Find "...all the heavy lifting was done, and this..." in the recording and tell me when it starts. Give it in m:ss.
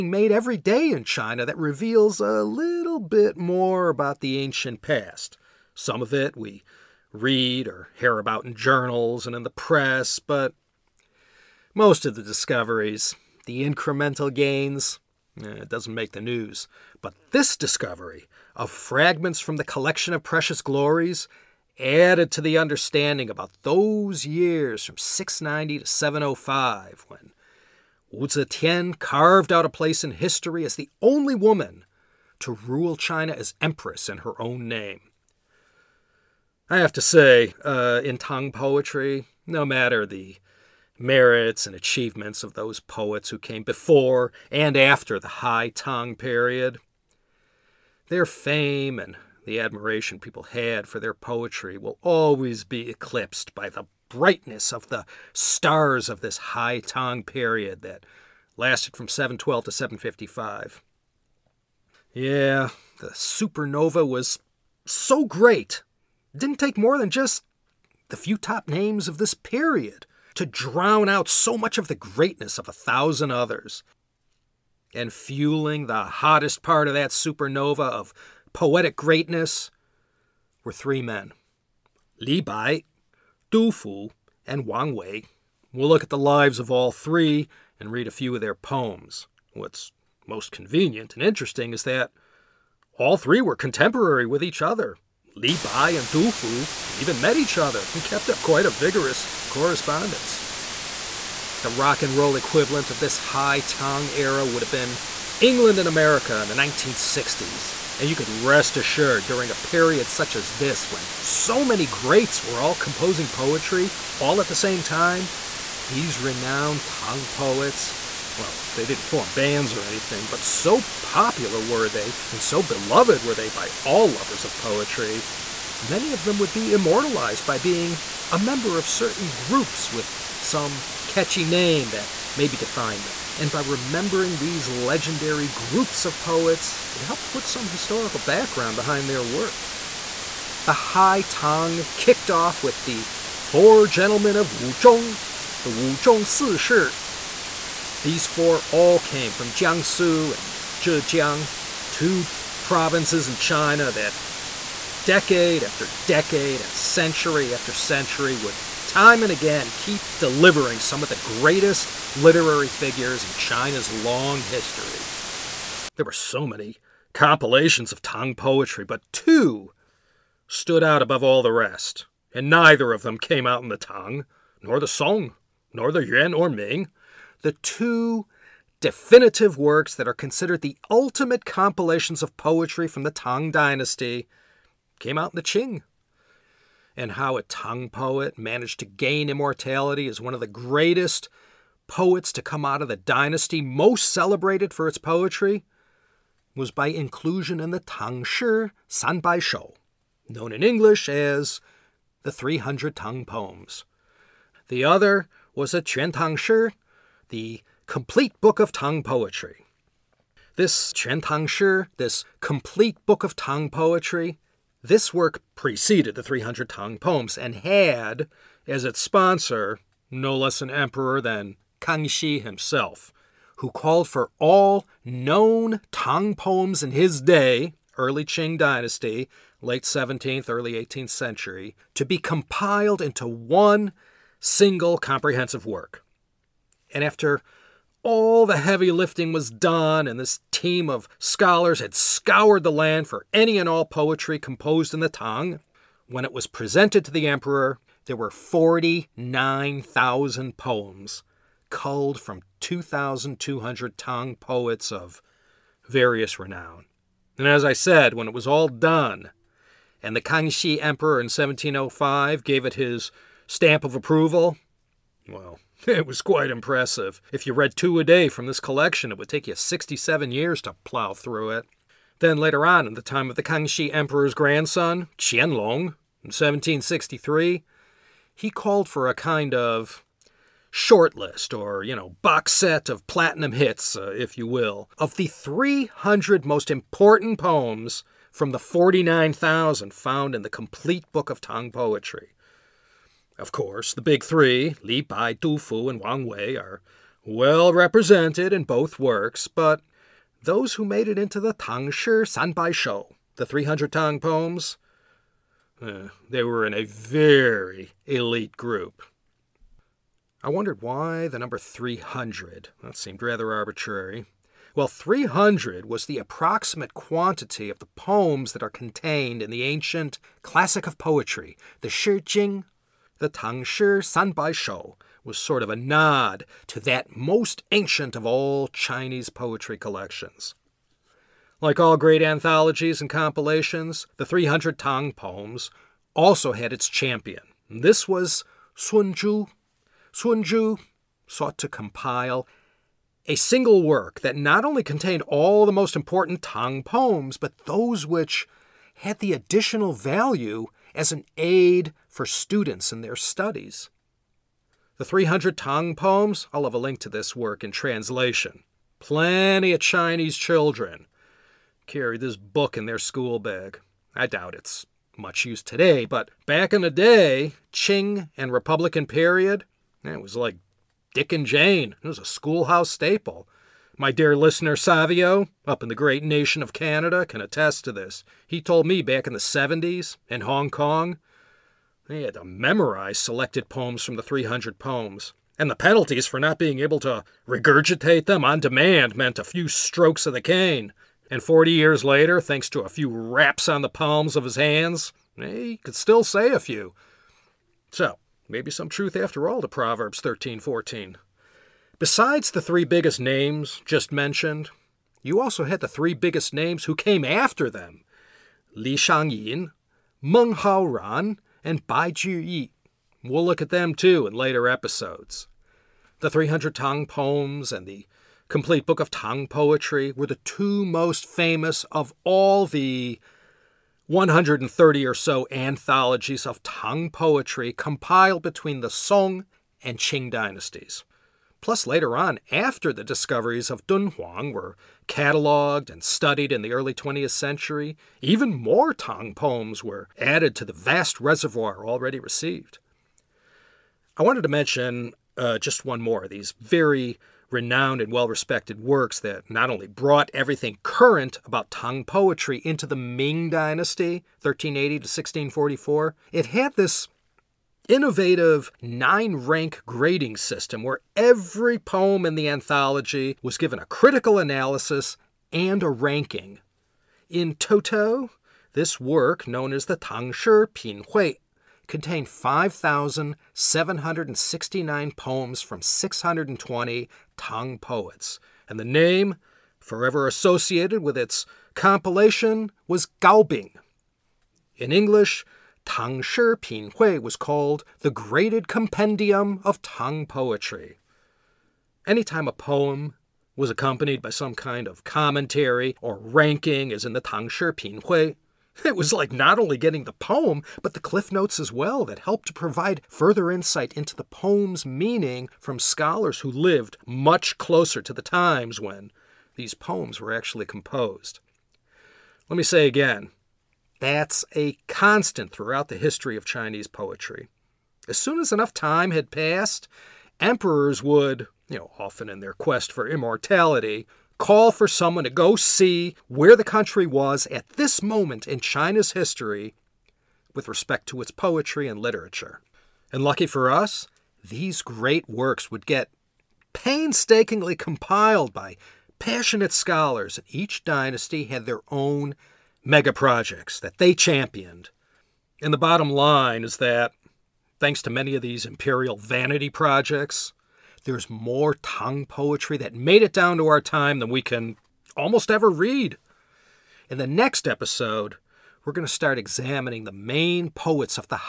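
3:58.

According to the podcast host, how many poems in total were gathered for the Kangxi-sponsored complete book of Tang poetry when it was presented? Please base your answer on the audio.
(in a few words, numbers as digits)
49,000.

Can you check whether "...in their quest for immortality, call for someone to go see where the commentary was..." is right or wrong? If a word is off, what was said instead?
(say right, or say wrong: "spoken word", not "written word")
wrong: "country", not "commentary".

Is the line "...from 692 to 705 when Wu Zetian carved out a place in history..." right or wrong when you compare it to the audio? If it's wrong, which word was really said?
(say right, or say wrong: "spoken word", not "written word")
wrong: "690", not "692".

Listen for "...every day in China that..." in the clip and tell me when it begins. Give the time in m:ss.
0:00.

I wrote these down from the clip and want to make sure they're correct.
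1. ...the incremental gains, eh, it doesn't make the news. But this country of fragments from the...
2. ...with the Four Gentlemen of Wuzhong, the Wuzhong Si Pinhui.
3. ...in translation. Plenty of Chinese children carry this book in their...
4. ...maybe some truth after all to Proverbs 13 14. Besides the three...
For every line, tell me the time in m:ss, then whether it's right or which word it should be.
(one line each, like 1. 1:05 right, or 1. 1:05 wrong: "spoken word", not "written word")
1. 0:13 wrong: "discovery", not "country"
2. 2:22 wrong: "Shi", not "Pinhui"
3. 5:57 right
4. 6:38 right.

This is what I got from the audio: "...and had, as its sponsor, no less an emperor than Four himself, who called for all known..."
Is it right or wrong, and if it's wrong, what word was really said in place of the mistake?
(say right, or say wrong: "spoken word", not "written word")
wrong: "Kangxi", not "Four".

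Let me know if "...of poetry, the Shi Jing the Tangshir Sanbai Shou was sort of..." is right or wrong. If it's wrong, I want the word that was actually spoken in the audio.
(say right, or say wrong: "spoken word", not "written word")
right.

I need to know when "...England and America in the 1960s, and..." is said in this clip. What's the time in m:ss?
1:45.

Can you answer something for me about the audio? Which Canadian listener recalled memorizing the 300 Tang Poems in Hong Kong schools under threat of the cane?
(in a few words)
Savio.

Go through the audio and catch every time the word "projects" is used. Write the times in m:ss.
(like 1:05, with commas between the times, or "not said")
9:03, 9:09.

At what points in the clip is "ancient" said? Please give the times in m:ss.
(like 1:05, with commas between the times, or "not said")
0:04, 5:19, 5:27.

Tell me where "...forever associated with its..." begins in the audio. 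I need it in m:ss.
7:59.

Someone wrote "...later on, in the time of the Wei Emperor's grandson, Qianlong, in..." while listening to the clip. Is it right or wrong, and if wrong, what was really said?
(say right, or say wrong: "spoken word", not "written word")
wrong: "Kangxi", not "Wei".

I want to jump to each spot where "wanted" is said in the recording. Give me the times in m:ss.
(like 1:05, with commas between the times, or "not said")
7:24.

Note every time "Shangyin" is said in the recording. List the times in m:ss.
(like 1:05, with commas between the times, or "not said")
6:48.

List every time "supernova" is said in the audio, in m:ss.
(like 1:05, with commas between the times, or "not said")
1:03, 1:17.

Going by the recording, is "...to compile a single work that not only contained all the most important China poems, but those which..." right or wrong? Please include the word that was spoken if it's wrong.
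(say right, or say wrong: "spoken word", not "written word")
wrong: "Tang", not "China".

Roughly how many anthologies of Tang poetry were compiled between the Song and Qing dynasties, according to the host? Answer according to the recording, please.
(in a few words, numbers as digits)
130.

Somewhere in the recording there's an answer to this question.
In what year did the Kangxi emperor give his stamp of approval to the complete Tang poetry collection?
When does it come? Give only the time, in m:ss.
4:21.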